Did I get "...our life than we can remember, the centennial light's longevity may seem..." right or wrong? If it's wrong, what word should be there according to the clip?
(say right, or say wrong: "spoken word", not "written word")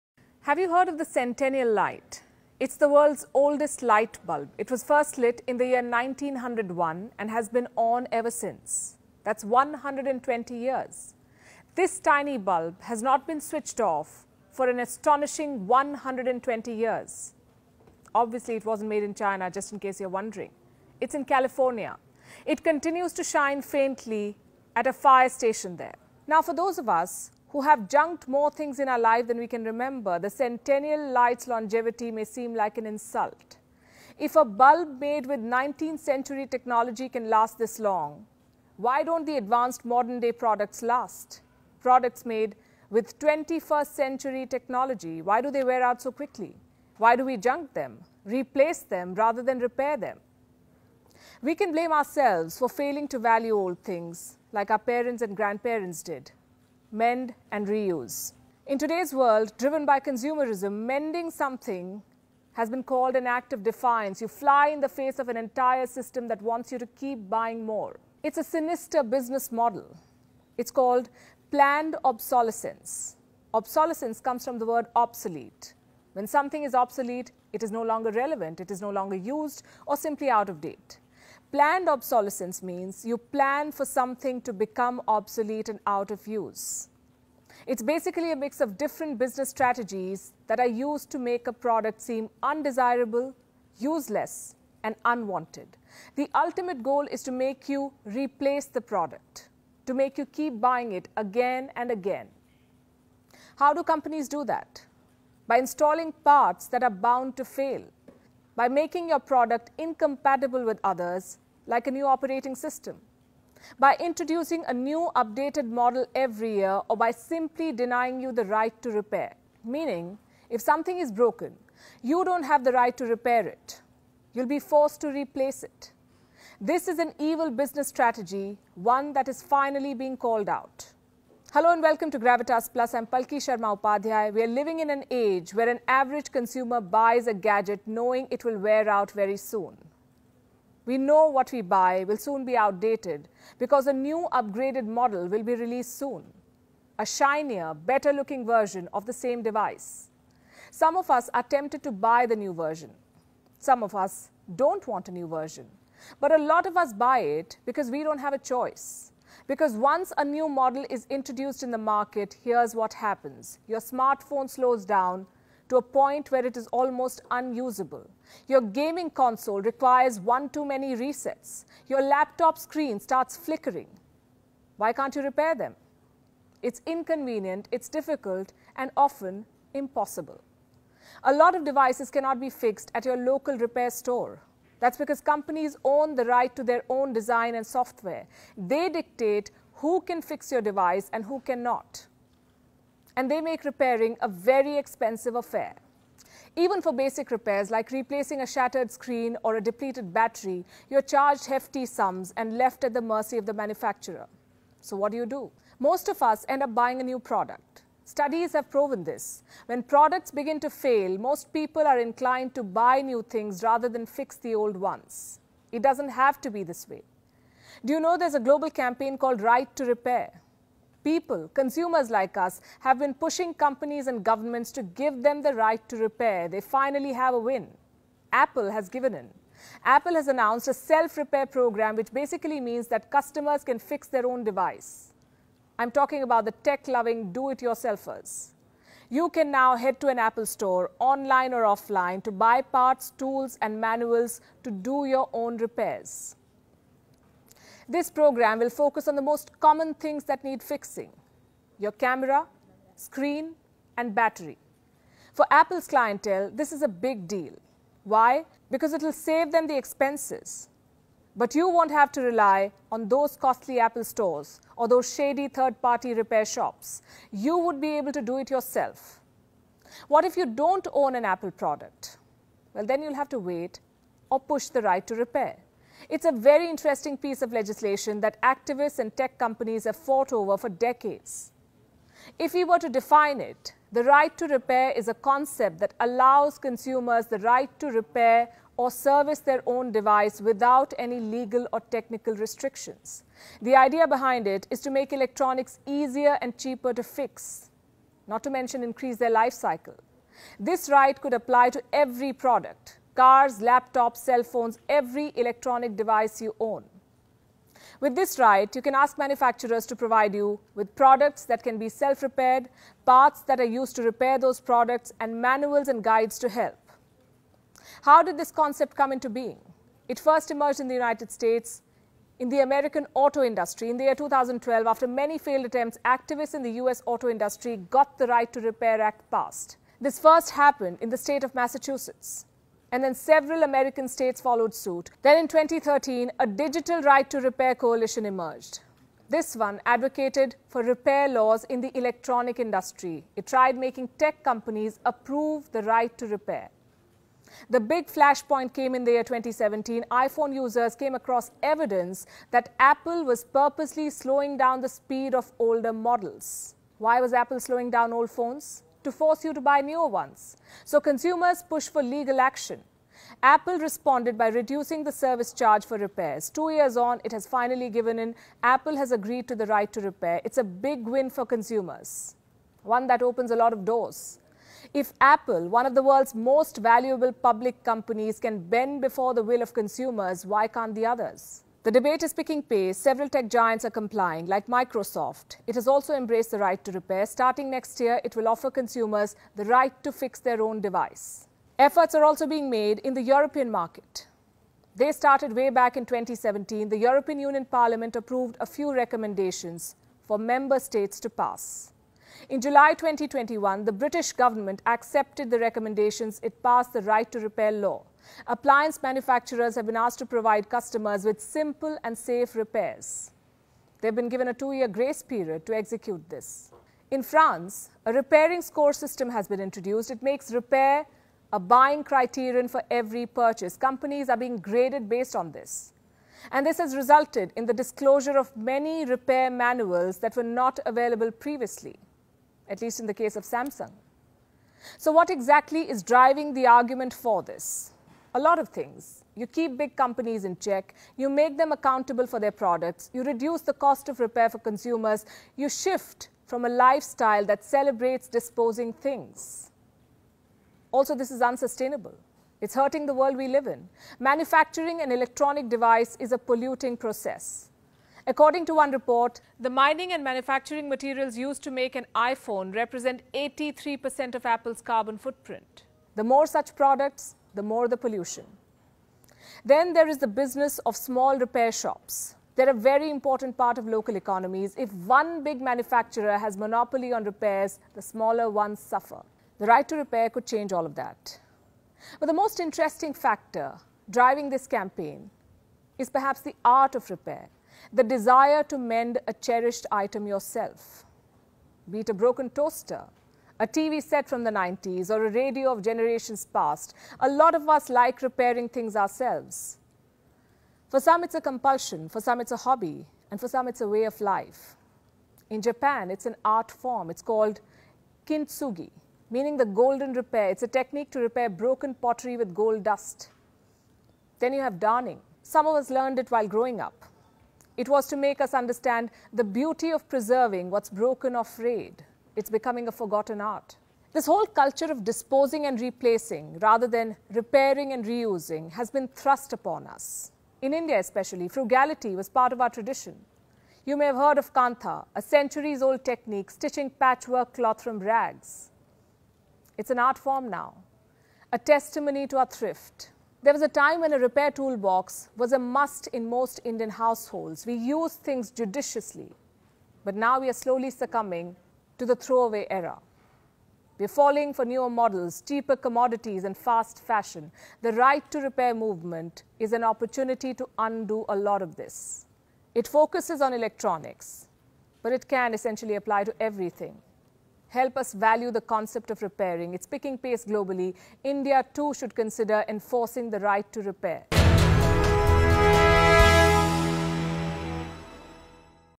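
right.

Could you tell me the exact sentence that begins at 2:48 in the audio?
Your gaming console requires one too many resets.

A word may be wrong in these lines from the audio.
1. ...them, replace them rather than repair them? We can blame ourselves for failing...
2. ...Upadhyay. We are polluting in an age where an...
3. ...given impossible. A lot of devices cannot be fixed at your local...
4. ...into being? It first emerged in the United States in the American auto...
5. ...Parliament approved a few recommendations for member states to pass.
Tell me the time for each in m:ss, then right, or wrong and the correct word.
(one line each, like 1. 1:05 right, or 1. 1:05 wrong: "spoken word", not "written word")
1. 0:47 right
2. 2:13 wrong: "living", not "polluting"
3. 2:58 wrong: "often", not "given"
4. 5:19 right
5. 6:37 right.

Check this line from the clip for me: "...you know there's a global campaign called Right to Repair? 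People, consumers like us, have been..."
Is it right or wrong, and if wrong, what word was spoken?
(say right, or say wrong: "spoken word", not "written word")
right.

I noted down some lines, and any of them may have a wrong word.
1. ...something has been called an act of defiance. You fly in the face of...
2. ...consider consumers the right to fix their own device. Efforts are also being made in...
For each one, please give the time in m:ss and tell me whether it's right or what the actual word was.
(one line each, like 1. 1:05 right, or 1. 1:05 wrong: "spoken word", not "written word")
1. 1:01 right
2. 6:28 wrong: "offer", not "consider".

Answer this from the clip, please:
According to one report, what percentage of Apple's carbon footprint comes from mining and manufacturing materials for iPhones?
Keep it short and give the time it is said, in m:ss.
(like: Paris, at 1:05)
83%, at 7:43.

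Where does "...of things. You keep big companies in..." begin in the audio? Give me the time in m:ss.
7:18.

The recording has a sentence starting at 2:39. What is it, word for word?
Because once a new model is introduced in the market, here's what happens.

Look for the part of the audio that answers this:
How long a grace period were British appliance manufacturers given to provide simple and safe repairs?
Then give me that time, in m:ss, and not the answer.
6:54.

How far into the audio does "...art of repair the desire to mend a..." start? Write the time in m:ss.
8:06.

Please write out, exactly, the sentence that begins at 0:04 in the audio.
It was first lit in the year 1901 and has been on ever since.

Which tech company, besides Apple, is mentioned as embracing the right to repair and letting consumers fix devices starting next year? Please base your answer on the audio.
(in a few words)
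Microsoft.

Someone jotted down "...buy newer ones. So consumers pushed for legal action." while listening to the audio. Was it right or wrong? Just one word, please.
right.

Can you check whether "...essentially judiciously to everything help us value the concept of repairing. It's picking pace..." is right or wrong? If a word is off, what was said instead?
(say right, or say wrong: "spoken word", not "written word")
wrong: "apply", not "judiciously".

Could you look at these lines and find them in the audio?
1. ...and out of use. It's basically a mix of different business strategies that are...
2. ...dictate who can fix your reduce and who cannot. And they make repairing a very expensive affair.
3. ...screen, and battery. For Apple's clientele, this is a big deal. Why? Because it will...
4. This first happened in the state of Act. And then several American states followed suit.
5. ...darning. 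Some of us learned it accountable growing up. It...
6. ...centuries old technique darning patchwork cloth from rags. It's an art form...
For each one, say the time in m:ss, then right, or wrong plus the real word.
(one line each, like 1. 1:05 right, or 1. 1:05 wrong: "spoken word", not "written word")
1. 1:25 right
2. 3:08 wrong: "device", not "reduce"
3. 4:12 right
4. 5:30 wrong: "Massachusetts", not "Act"
5. 8:34 wrong: "while", not "accountable"
6. 8:55 wrong: "stitching", not "darning".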